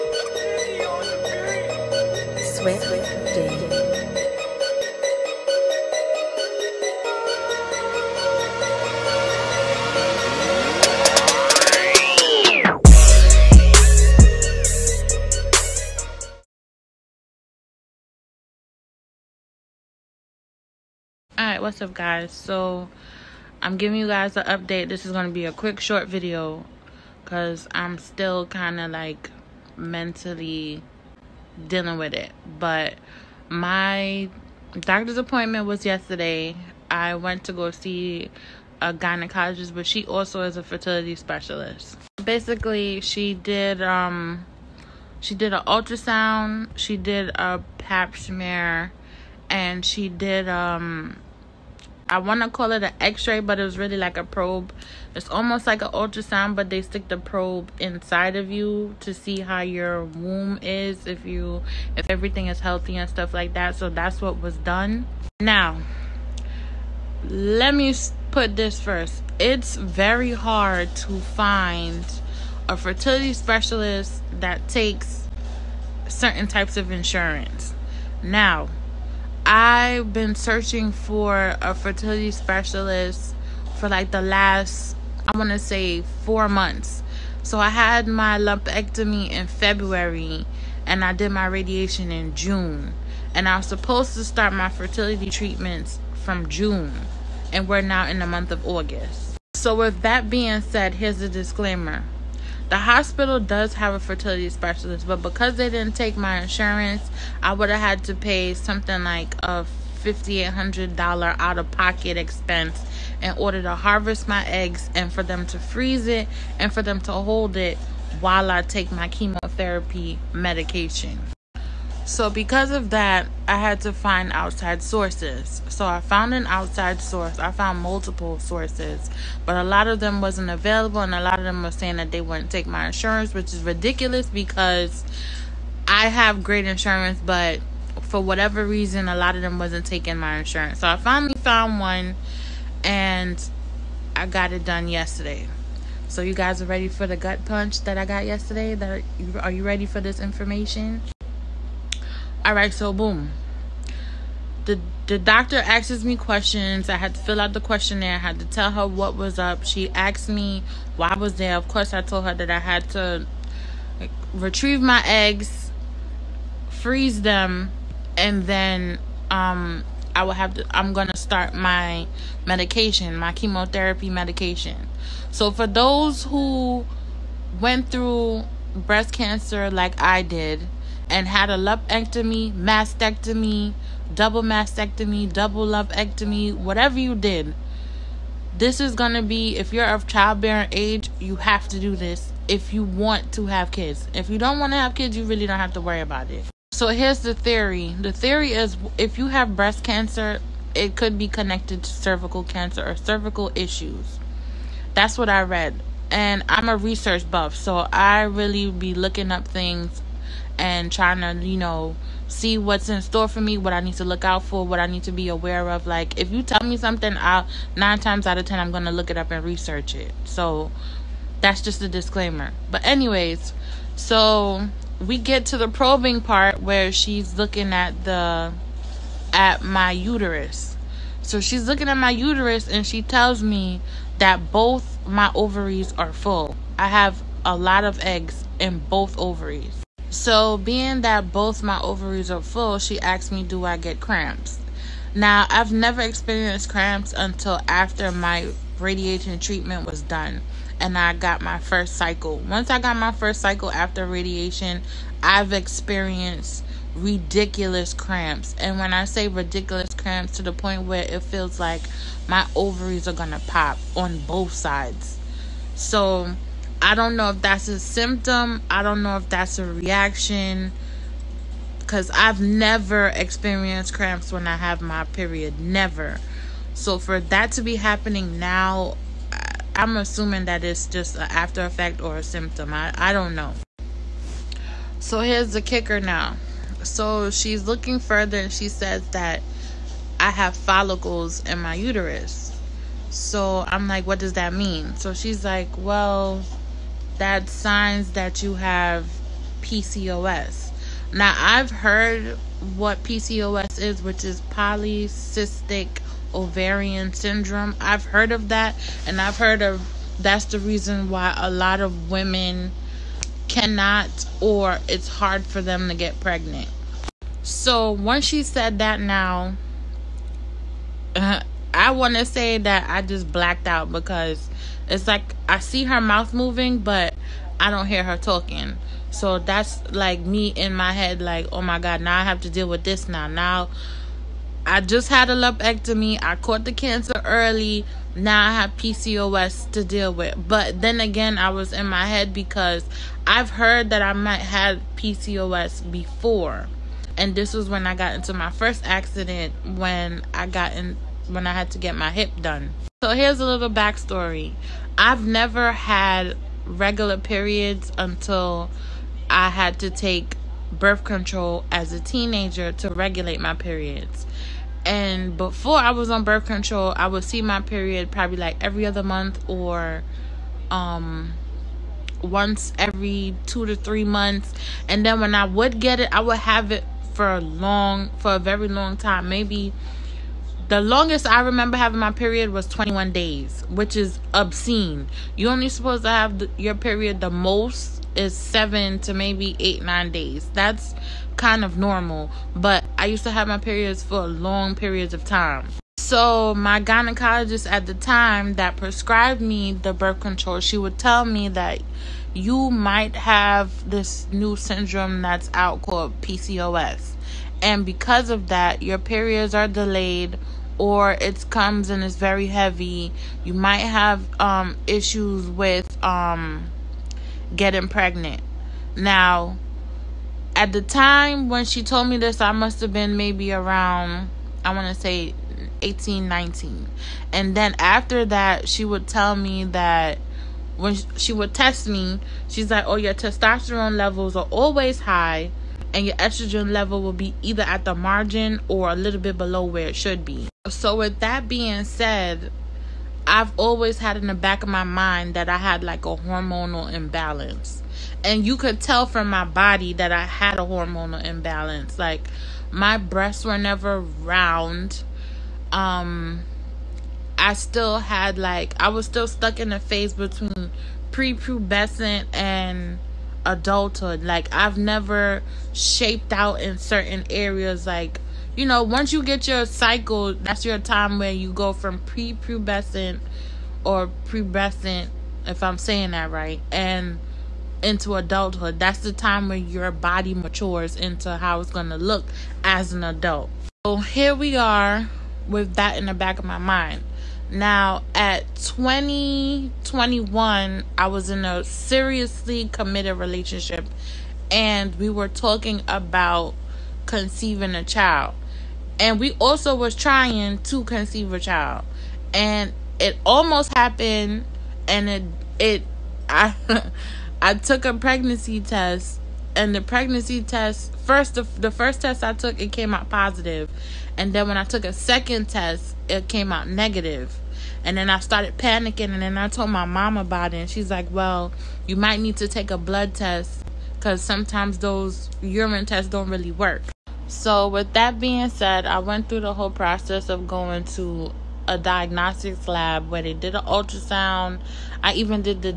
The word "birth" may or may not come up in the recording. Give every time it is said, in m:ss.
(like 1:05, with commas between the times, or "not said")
6:00, 6:06, 6:39.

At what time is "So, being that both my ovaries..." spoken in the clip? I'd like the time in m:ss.
4:00.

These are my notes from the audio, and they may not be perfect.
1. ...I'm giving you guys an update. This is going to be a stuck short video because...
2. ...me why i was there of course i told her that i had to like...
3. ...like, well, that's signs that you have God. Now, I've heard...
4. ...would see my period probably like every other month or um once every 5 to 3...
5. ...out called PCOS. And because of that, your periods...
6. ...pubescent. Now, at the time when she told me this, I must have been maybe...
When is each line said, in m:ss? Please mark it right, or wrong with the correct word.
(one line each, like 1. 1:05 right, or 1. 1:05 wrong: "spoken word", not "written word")
1. 0:23 wrong: "quick", not "stuck"
2. 2:40 right
3. 4:55 wrong: "PCOS", not "God"
4. 6:07 wrong: "2", not "5"
5. 6:45 right
6. 6:57 wrong: "pregnant", not "pubescent".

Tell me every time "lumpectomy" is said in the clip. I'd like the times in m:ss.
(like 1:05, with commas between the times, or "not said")
1:28, 3:01, 3:05, 5:35.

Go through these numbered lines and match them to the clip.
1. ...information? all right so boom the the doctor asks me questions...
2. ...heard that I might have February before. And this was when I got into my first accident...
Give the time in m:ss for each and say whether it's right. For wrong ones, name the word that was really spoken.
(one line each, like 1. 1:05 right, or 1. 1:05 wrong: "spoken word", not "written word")
1. 2:30 right
2. 5:43 wrong: "PCOS", not "February".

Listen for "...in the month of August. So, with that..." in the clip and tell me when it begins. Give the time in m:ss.
1:38.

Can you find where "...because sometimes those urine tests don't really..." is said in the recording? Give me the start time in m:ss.
8:43.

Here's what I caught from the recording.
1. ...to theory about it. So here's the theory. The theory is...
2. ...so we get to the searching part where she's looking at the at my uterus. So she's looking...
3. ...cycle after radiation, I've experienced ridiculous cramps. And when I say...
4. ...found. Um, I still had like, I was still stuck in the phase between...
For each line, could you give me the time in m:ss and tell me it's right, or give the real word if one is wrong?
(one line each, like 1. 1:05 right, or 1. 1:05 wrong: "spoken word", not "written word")
1. 3:15 wrong: "worry", not "theory"
2. 3:43 wrong: "probing", not "searching"
3. 4:13 right
4. 7:34 wrong: "round", not "found".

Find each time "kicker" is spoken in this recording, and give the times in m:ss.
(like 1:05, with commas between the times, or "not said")
4:45.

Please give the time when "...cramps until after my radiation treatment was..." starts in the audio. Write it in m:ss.
4:06.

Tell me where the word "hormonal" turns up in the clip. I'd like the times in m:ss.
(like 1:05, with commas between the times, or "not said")
7:26, 7:30.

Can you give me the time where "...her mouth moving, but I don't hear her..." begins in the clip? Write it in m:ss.
5:25.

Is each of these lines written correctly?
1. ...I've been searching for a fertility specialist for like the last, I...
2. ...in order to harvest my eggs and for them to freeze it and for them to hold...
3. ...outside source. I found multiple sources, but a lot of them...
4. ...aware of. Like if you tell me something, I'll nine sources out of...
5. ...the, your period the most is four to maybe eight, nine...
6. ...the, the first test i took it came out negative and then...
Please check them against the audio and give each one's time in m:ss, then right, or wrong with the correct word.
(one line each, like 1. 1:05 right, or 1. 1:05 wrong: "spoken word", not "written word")
1. 1:19 right
2. 1:53 right
3. 2:06 right
4. 3:35 wrong: "times", not "sources"
5. 6:26 wrong: "seven", not "four"
6. 8:31 wrong: "positive", not "negative".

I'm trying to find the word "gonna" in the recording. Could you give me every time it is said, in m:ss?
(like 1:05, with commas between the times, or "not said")
2:50, 3:38, 4:23.